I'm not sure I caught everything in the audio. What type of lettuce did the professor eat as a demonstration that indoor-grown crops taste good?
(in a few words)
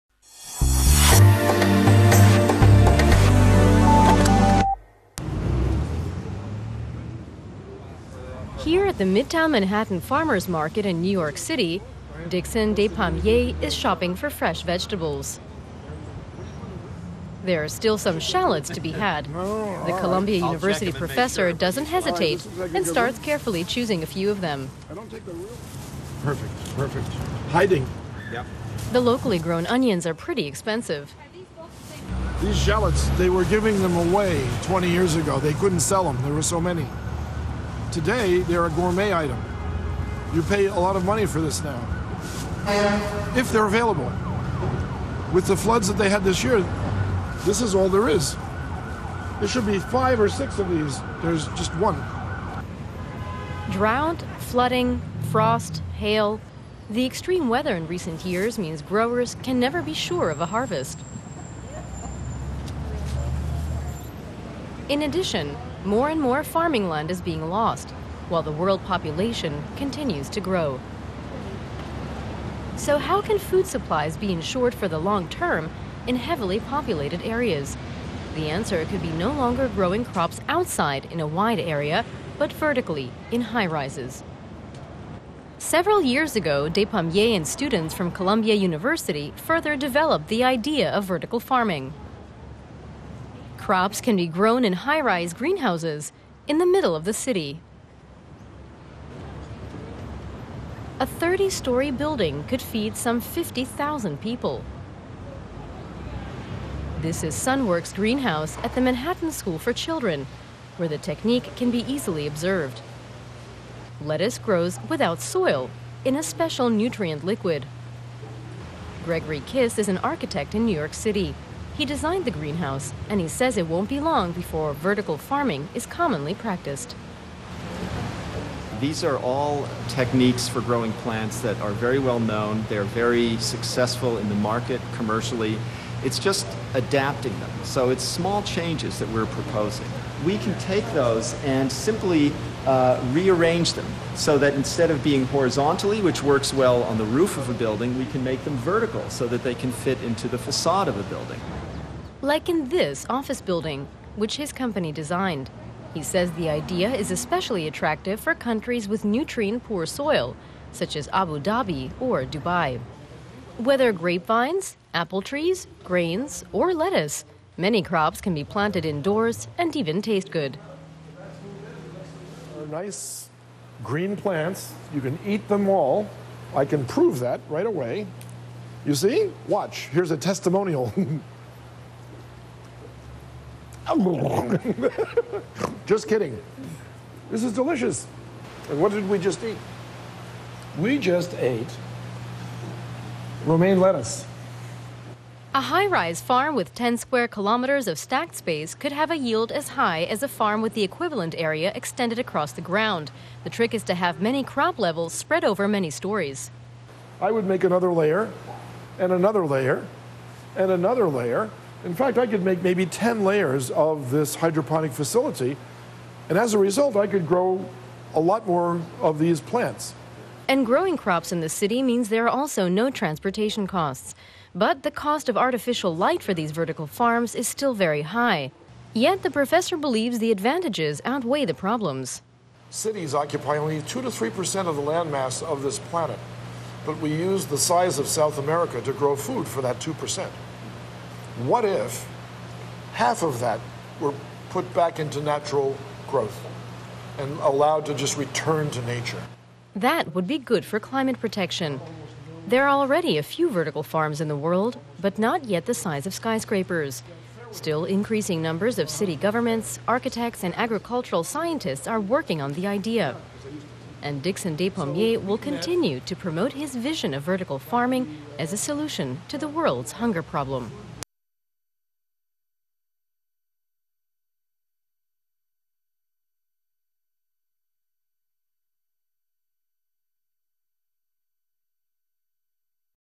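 Romaine lettuce.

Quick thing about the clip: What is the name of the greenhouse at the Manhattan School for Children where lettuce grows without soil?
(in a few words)
Sunworks Greenhouse.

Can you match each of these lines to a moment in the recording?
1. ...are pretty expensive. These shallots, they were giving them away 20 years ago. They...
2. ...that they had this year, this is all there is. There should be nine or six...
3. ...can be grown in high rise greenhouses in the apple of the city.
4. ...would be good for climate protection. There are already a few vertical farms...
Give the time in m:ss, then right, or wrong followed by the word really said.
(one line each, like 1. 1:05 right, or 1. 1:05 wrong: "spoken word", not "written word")
1. 0:30 right
2. 0:45 wrong: "five", not "nine"
3. 1:34 wrong: "middle", not "apple"
4. 4:10 right.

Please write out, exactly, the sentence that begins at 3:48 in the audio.
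Yet the professor believes the advantages outweigh the problems.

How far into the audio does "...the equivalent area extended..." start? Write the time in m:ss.
3:20.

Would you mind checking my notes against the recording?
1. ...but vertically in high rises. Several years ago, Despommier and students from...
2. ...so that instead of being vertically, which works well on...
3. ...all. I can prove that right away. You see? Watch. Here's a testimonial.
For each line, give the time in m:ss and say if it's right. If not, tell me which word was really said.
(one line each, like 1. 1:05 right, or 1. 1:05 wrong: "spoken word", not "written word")
1. 1:22 right
2. 2:24 wrong: "horizontally", not "vertically"
3. 2:55 right.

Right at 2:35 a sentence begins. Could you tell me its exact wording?
He says the idea is especially attractive for countries with nutrient poor soil, such as Abu Dhabi or Dubai.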